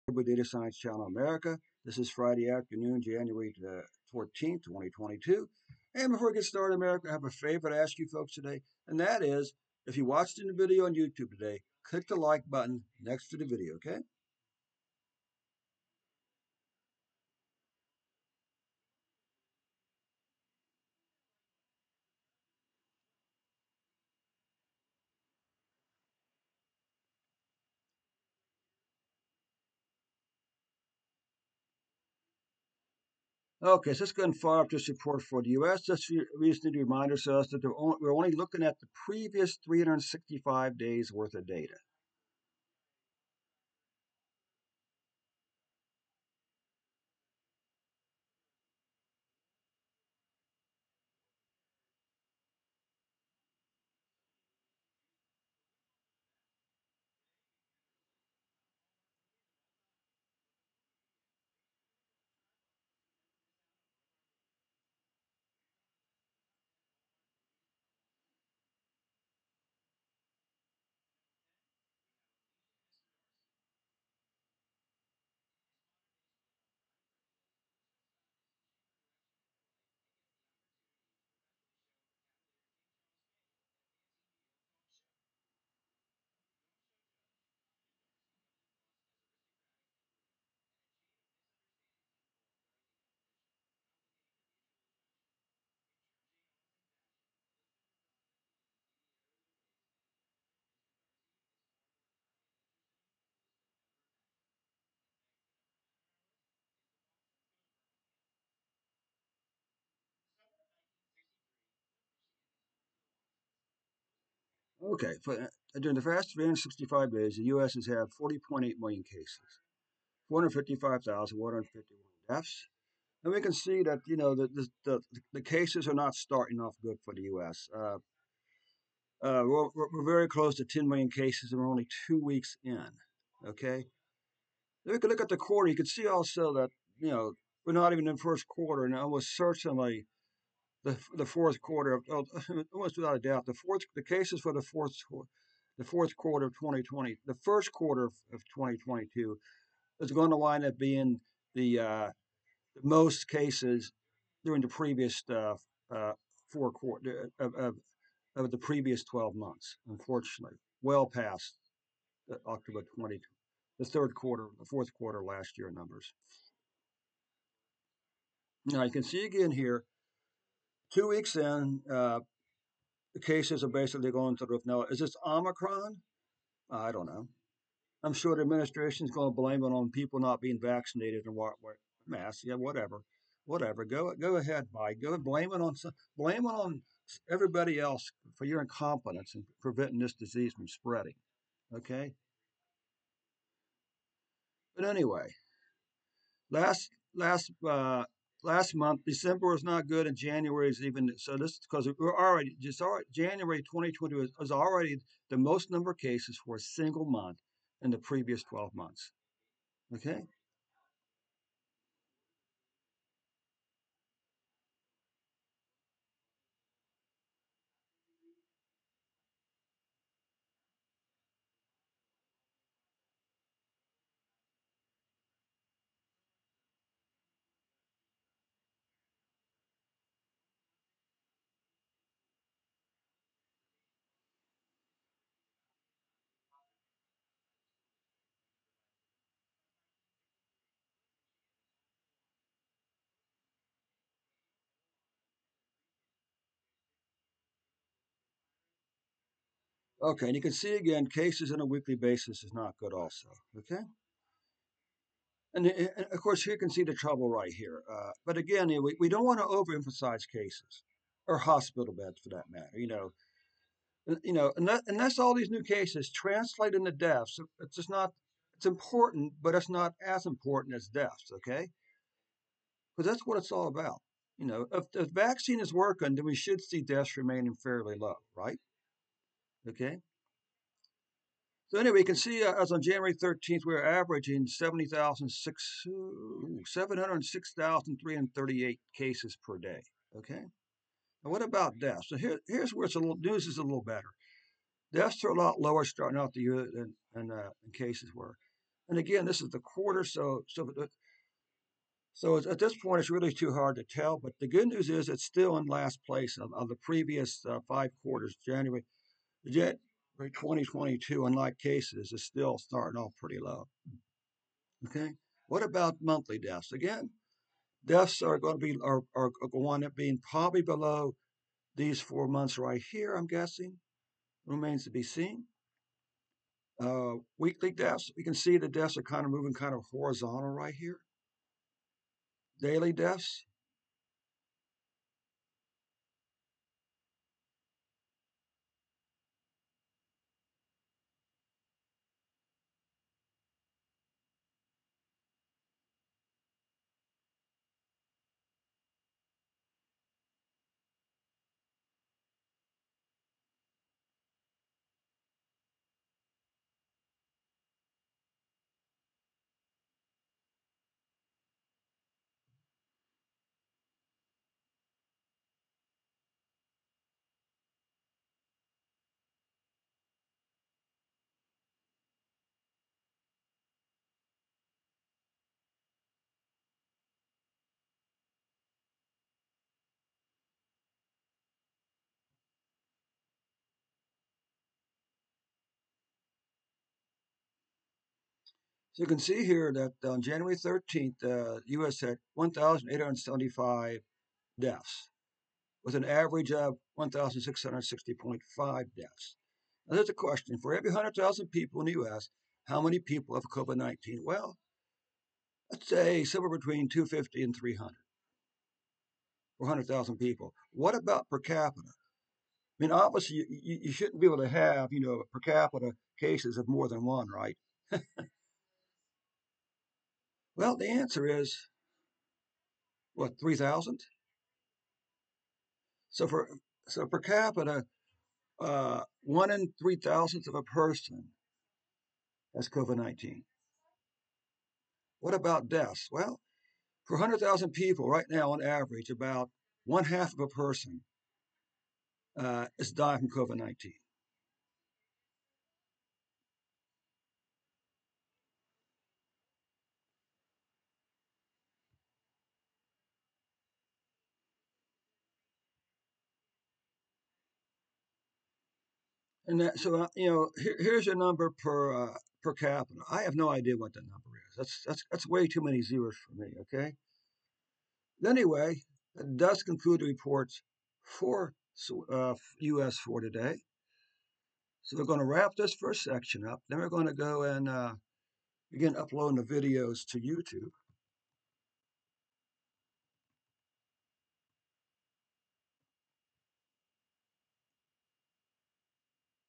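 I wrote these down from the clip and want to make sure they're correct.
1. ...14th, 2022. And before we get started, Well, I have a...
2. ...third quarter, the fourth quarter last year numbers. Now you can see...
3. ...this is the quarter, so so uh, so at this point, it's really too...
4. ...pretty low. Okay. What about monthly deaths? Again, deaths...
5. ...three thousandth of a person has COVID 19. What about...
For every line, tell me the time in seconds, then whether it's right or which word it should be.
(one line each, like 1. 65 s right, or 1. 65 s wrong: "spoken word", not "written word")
1. 4 s wrong: "America", not "Well"
2. 163 s right
3. 299 s right
4. 313 s right
5. 429 s right.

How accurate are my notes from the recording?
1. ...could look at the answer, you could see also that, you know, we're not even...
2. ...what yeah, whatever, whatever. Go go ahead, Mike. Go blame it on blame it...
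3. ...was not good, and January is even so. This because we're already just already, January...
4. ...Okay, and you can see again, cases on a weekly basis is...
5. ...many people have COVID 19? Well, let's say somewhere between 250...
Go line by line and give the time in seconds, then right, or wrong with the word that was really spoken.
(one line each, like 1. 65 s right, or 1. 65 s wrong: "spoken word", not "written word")
1. 134 s wrong: "quarter", not "answer"
2. 181 s right
3. 199 s right
4. 250 s right
5. 402 s right.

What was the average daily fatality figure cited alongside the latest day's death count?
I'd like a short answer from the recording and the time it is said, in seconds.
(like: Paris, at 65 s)
1,660.5, at 396 s.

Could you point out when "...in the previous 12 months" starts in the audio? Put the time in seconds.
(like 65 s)
207 s.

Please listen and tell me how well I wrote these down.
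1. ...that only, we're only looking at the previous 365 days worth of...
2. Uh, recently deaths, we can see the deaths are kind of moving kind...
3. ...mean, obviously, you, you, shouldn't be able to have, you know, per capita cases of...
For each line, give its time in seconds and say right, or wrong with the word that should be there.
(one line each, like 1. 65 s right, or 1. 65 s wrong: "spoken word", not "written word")
1. 37 s right
2. 326 s wrong: "weekly", not "recently"
3. 412 s right.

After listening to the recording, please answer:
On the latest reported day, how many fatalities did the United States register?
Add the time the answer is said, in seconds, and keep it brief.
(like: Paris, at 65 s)
1,875, at 392 s.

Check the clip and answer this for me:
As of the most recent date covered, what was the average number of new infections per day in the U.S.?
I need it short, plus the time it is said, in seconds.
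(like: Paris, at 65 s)
706,338, at 284 s.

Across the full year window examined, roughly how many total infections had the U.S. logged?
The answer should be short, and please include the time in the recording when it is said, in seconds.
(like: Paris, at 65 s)
40.8 million, at 118 s.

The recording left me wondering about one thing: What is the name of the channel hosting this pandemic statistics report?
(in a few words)
Data Science Channel America.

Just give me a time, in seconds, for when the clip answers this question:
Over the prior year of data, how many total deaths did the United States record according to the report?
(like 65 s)
120 s.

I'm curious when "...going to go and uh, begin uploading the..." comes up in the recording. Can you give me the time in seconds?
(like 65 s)
476 s.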